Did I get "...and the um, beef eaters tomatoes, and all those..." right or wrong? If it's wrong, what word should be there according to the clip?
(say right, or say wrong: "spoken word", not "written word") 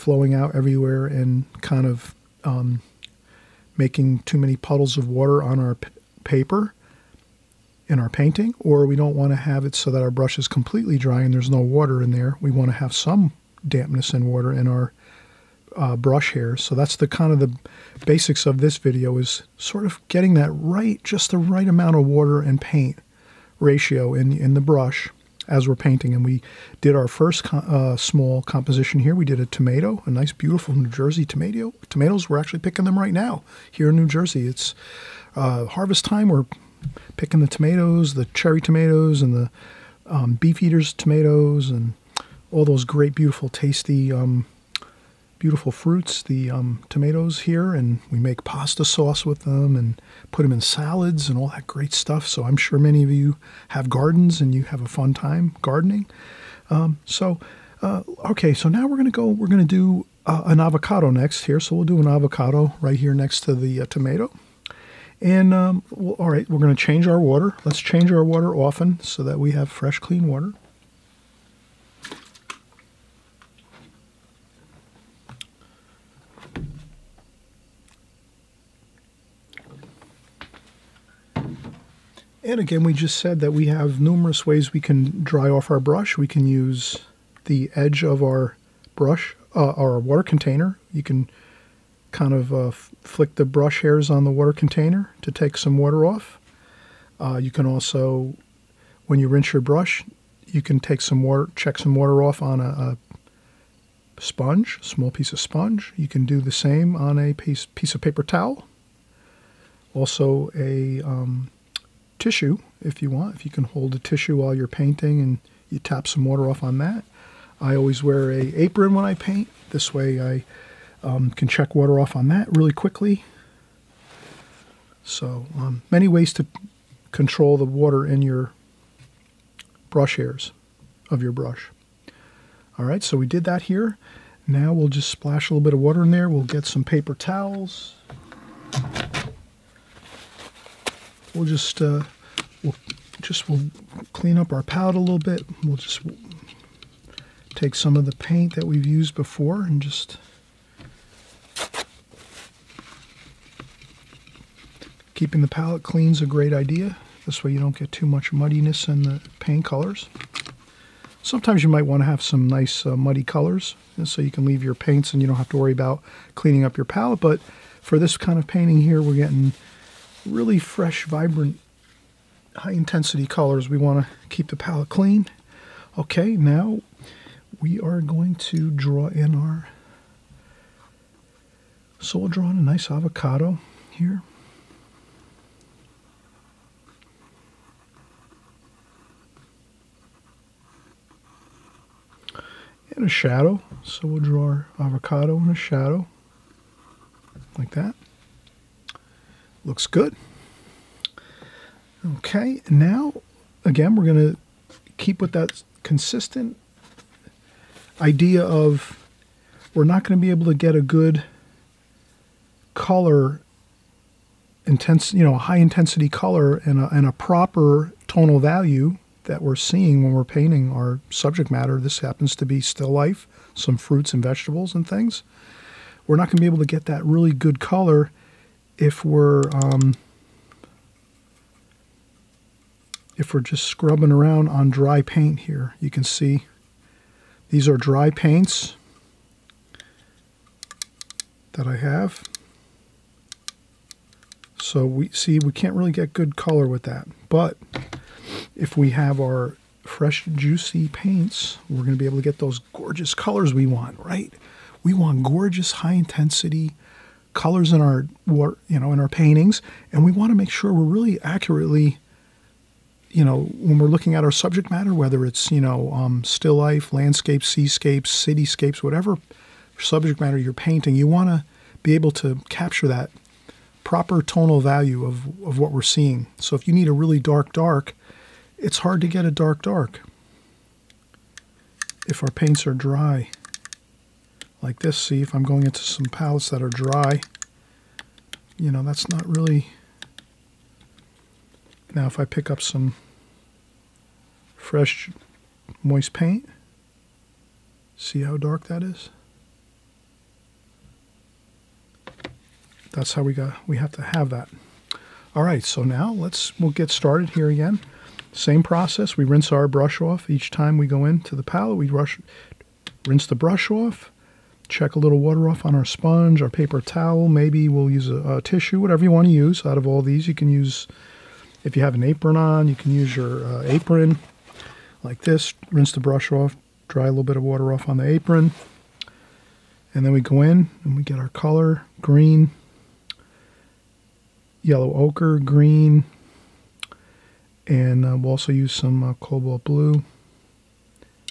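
right.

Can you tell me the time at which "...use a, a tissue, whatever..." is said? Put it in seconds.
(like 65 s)
317 s.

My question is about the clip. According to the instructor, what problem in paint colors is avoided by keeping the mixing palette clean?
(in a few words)
muddiness.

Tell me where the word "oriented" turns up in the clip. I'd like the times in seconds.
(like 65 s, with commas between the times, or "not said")
not said.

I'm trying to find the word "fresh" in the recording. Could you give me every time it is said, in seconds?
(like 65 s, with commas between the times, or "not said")
69 s, 170 s, 249 s, 294 s.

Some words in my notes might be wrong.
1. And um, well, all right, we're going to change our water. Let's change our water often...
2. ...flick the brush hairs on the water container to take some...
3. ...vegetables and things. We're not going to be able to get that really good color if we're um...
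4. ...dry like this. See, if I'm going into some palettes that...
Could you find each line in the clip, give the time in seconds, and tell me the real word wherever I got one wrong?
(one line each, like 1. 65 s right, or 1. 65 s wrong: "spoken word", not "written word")
1. 65 s right
2. 92 s right
3. 224 s right
4. 282 s right.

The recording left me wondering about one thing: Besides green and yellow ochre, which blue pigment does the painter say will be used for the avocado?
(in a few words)
cobalt blue.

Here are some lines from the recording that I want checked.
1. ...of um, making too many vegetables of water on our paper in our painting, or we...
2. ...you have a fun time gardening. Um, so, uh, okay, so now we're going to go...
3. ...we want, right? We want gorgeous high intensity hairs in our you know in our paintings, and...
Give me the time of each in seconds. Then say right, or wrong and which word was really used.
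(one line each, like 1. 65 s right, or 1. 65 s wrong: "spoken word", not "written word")
1. 1 s wrong: "puddles", not "vegetables"
2. 54 s right
3. 253 s wrong: "colors", not "hairs".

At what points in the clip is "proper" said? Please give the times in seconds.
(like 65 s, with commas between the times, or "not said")
217 s, 273 s.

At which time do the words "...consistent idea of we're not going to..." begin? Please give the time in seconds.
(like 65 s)
205 s.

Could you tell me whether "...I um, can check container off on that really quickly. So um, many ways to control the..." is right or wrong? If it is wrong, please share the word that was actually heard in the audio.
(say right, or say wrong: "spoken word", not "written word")
wrong: "water", not "container".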